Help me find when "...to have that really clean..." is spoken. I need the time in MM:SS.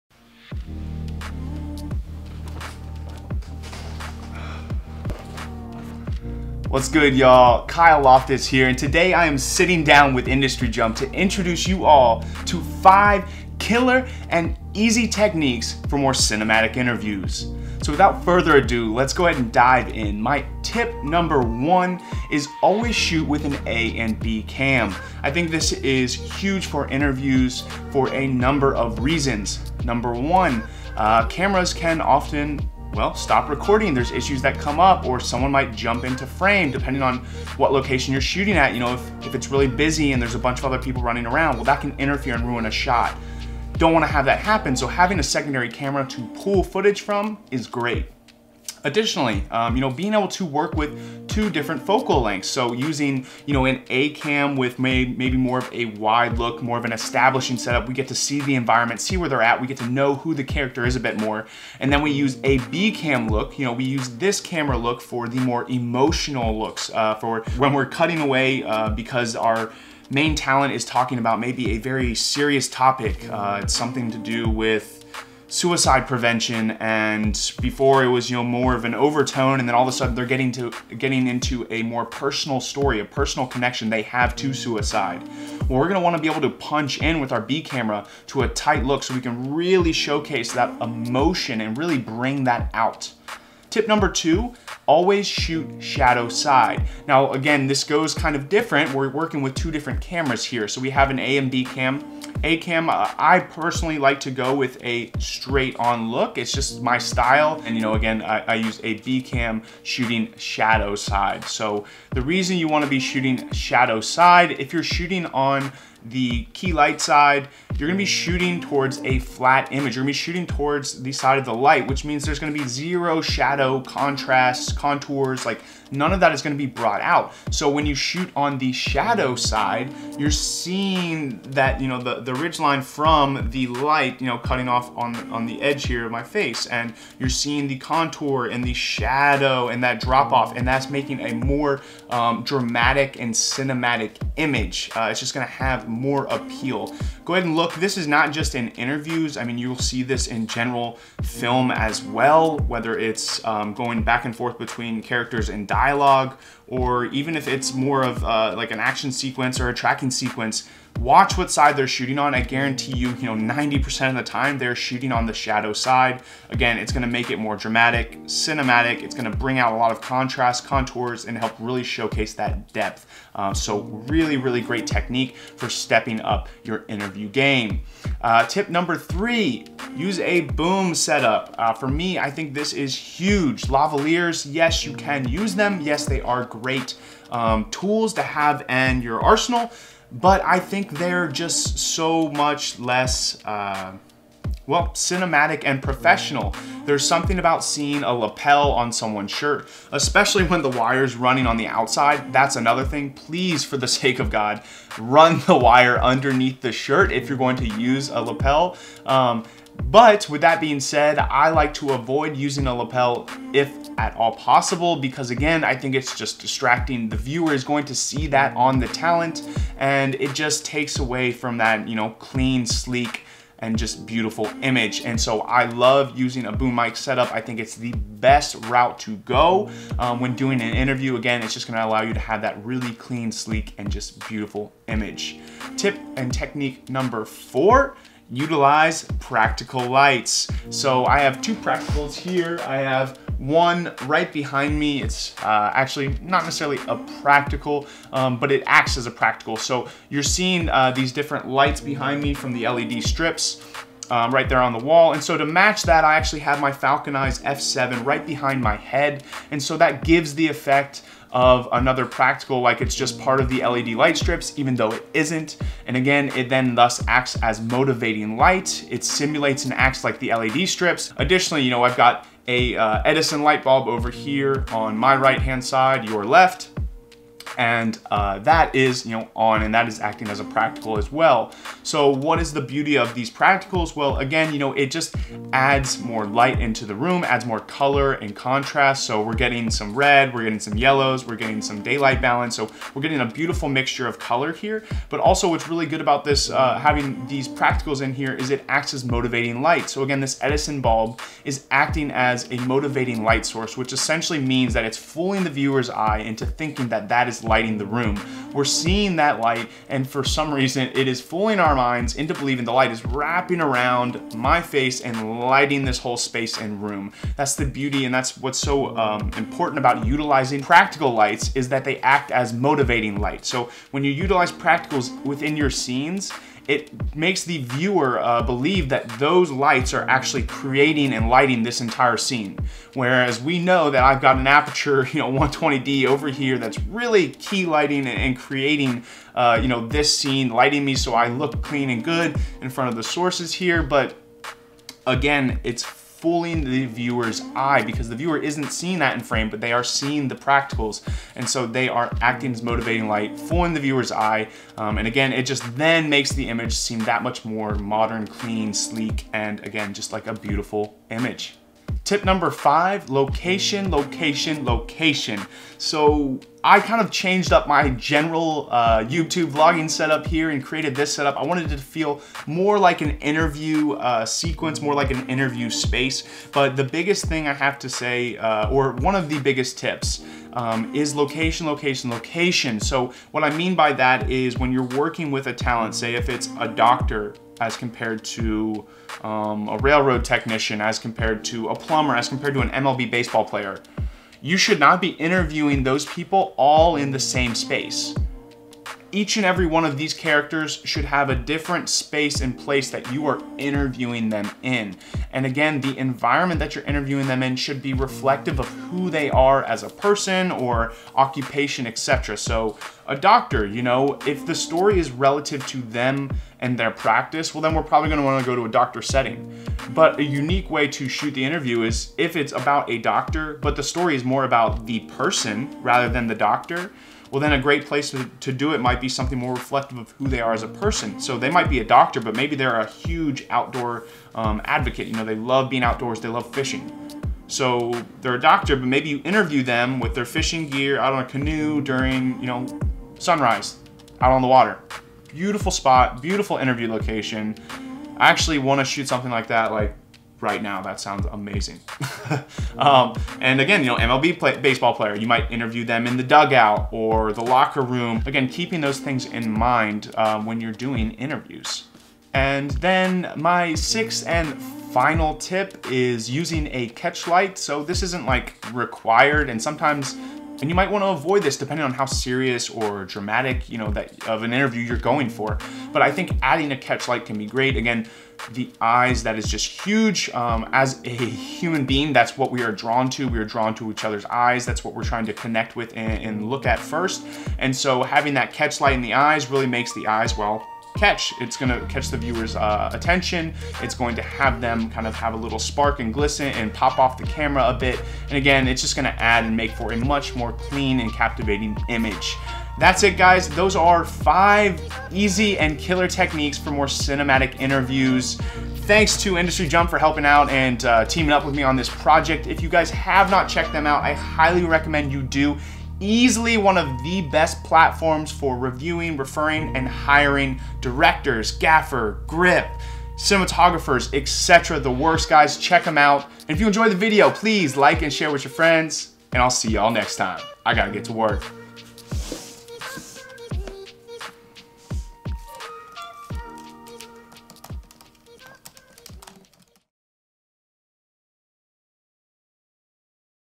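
03:52.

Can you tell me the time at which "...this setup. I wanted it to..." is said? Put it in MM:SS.
06:10.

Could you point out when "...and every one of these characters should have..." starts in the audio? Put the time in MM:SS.
06:39.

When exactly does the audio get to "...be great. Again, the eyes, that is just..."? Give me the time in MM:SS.
07:57.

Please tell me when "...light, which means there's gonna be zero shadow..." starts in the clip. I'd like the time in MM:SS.
02:01.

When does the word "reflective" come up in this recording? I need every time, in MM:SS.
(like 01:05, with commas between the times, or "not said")
06:47, 07:09.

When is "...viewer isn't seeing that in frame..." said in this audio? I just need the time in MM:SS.
05:48.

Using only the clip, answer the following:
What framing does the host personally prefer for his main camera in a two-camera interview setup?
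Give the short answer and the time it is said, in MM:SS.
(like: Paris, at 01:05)
straight on, at 01:45.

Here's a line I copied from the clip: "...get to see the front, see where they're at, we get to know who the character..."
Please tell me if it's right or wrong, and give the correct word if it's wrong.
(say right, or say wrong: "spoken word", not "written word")
wrong: "environment", not "front".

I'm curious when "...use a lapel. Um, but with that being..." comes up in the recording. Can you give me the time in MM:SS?
03:27.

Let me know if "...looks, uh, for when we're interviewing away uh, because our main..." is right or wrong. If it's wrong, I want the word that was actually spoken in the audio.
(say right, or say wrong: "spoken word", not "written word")
wrong: "cutting", not "interviewing".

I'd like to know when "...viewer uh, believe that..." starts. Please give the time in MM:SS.
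05:27.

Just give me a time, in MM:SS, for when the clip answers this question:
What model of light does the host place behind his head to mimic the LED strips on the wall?
04:16.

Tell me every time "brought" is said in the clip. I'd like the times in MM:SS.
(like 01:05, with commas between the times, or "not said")
02:06.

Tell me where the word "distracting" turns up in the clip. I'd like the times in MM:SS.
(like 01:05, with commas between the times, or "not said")
03:36.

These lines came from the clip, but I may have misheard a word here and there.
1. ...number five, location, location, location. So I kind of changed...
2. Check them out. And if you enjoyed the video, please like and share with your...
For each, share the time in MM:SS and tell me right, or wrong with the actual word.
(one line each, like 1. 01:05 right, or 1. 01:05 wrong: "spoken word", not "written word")
1. 06:02 right
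2. 08:45 right.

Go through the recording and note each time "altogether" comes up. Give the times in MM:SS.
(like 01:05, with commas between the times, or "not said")
not said.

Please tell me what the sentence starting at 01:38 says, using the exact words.
We're working with two different cameras here.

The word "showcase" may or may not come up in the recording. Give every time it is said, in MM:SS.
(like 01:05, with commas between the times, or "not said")
01:29, 02:51.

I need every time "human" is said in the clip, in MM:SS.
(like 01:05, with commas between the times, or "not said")
08:01.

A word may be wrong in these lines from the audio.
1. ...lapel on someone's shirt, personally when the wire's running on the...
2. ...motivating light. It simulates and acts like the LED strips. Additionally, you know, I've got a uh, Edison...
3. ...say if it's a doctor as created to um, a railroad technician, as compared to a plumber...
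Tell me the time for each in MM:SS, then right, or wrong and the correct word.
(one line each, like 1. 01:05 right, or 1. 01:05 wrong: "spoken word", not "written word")
1. 03:18 wrong: "especially", not "personally"
2. 04:27 right
3. 06:25 wrong: "compared", not "created".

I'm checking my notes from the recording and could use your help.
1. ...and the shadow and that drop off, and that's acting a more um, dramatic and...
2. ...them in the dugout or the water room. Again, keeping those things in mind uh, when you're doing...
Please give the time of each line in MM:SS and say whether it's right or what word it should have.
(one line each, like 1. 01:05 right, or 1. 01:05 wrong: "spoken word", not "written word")
1. 02:18 wrong: "making", not "acting"
2. 07:35 wrong: "locker", not "water".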